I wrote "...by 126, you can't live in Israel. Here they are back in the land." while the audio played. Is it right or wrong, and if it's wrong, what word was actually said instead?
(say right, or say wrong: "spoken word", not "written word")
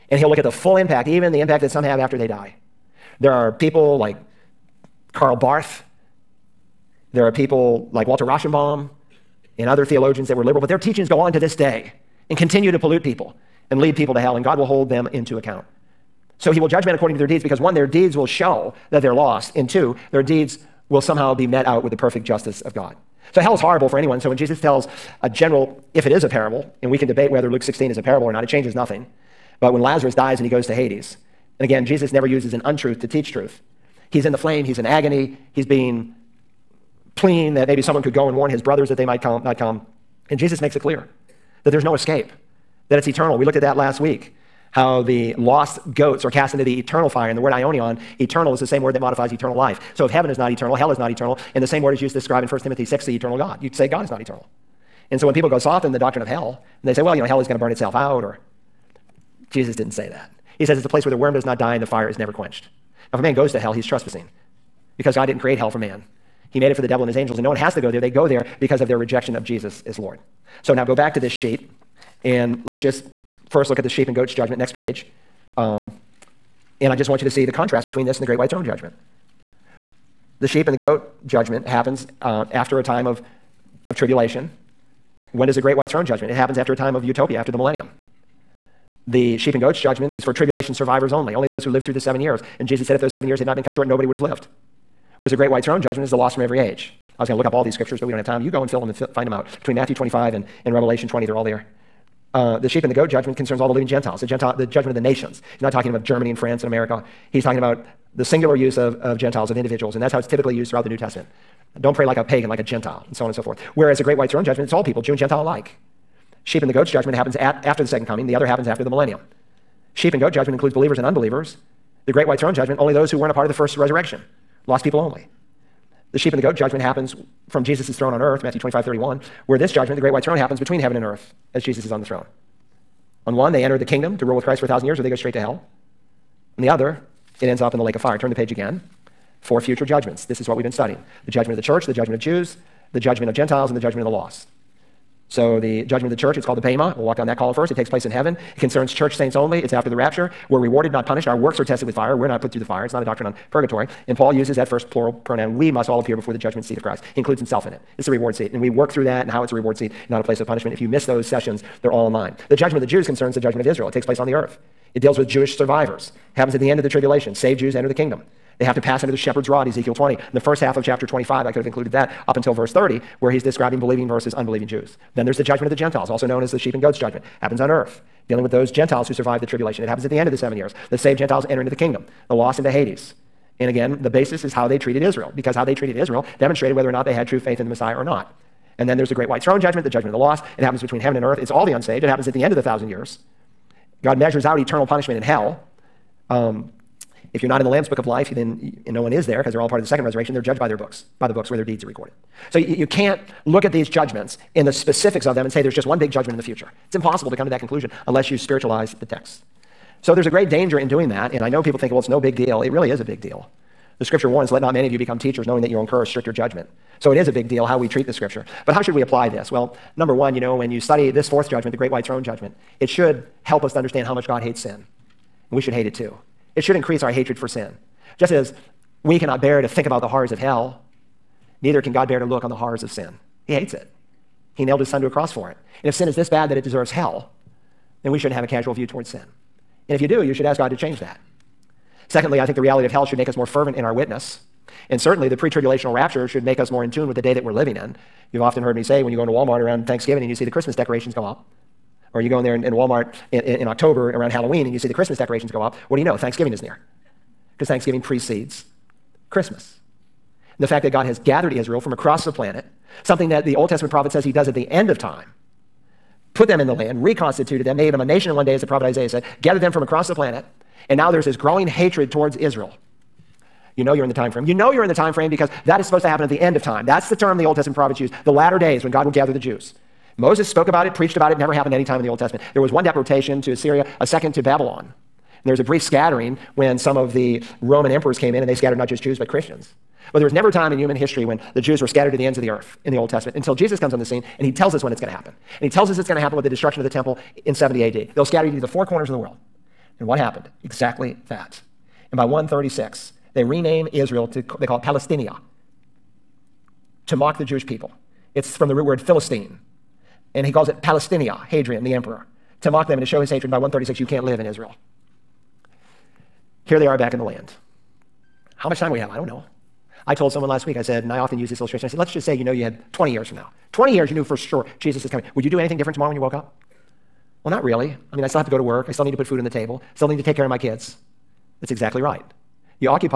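wrong: "136", not "126".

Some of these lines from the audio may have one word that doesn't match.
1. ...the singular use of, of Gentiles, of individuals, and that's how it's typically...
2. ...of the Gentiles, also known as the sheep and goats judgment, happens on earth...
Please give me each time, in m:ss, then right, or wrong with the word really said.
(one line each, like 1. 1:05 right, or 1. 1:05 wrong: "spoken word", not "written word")
1. 1:48 right
2. 2:55 right.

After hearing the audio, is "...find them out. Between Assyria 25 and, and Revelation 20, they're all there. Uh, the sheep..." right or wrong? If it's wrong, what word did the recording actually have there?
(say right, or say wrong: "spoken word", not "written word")
wrong: "Matthew", not "Assyria".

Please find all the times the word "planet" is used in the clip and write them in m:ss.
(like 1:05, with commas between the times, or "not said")
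4:22, 4:30.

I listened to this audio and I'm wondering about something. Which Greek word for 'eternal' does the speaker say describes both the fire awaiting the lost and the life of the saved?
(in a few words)
aionion.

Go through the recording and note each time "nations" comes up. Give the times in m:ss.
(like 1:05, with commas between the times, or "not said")
1:44, 4:28.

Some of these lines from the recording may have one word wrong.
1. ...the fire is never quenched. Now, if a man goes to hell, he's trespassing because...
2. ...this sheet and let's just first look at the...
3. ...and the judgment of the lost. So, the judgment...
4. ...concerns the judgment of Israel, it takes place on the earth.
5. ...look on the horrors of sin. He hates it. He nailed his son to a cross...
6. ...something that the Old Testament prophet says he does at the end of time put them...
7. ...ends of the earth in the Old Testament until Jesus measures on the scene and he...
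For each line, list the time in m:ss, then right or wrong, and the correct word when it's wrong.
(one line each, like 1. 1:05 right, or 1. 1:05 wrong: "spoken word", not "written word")
1. 1:01 right
2. 1:11 right
3. 2:23 right
4. 2:43 right
5. 3:52 right
6. 4:23 right
7. 4:52 wrong: "comes", not "measures".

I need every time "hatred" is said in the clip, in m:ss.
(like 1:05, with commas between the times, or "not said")
3:47, 4:31, 5:13.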